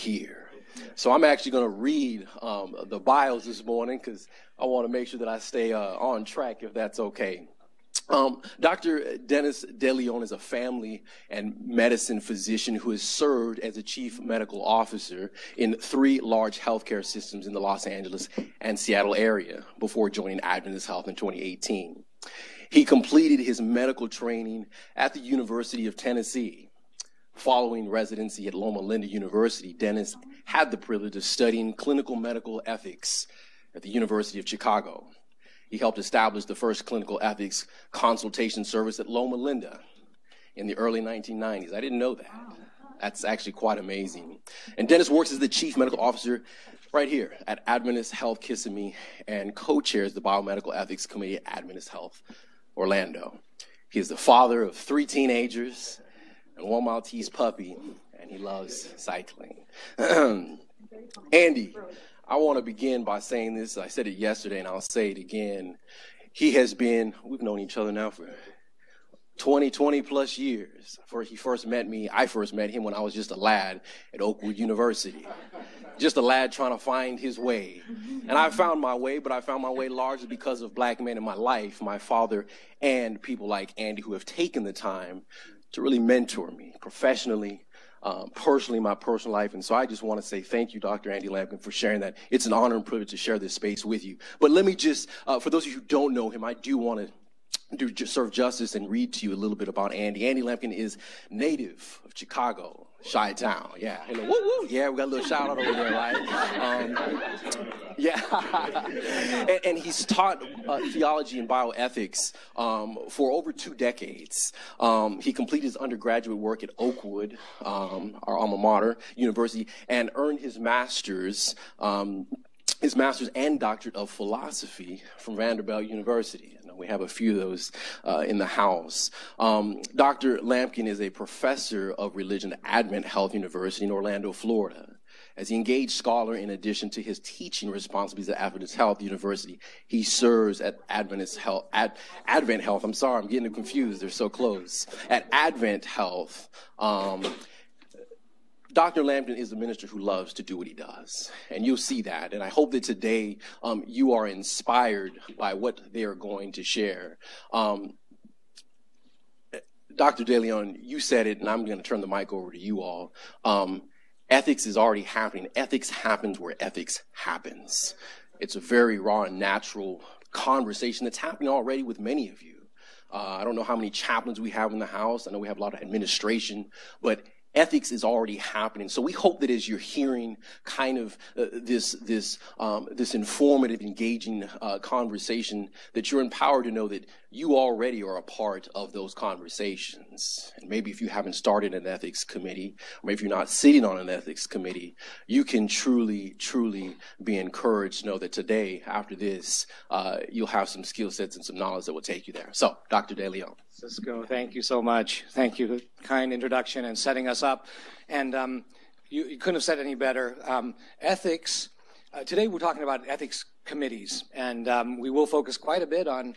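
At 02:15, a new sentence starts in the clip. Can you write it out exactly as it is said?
As the engaged scholar, in addition to his teaching responsibilities at Adventist Health University, he serves at Adventist Health, Advent Health.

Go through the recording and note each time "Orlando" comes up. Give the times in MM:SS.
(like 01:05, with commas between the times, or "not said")
00:52, 02:13.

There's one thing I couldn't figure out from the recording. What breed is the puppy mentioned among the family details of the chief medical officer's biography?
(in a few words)
Maltese.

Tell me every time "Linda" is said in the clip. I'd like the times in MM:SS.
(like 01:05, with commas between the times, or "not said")
00:28, 00:39.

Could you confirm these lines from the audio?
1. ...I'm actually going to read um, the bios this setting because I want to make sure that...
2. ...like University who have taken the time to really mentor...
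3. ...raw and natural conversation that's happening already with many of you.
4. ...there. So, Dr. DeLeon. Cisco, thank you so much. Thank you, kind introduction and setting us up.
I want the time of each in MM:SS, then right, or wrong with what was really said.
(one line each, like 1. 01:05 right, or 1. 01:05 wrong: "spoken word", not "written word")
1. 00:01 wrong: "morning", not "setting"
2. 01:23 wrong: "Andy", not "University"
3. 02:48 right
4. 03:22 right.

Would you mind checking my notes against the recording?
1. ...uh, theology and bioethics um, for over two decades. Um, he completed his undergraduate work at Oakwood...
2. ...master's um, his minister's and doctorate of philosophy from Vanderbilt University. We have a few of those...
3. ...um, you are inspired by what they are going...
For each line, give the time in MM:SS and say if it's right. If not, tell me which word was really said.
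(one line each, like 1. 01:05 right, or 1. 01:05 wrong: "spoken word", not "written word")
1. 01:50 right
2. 02:00 wrong: "master", not "minister"
3. 02:33 right.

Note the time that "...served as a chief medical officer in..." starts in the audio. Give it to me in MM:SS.
00:13.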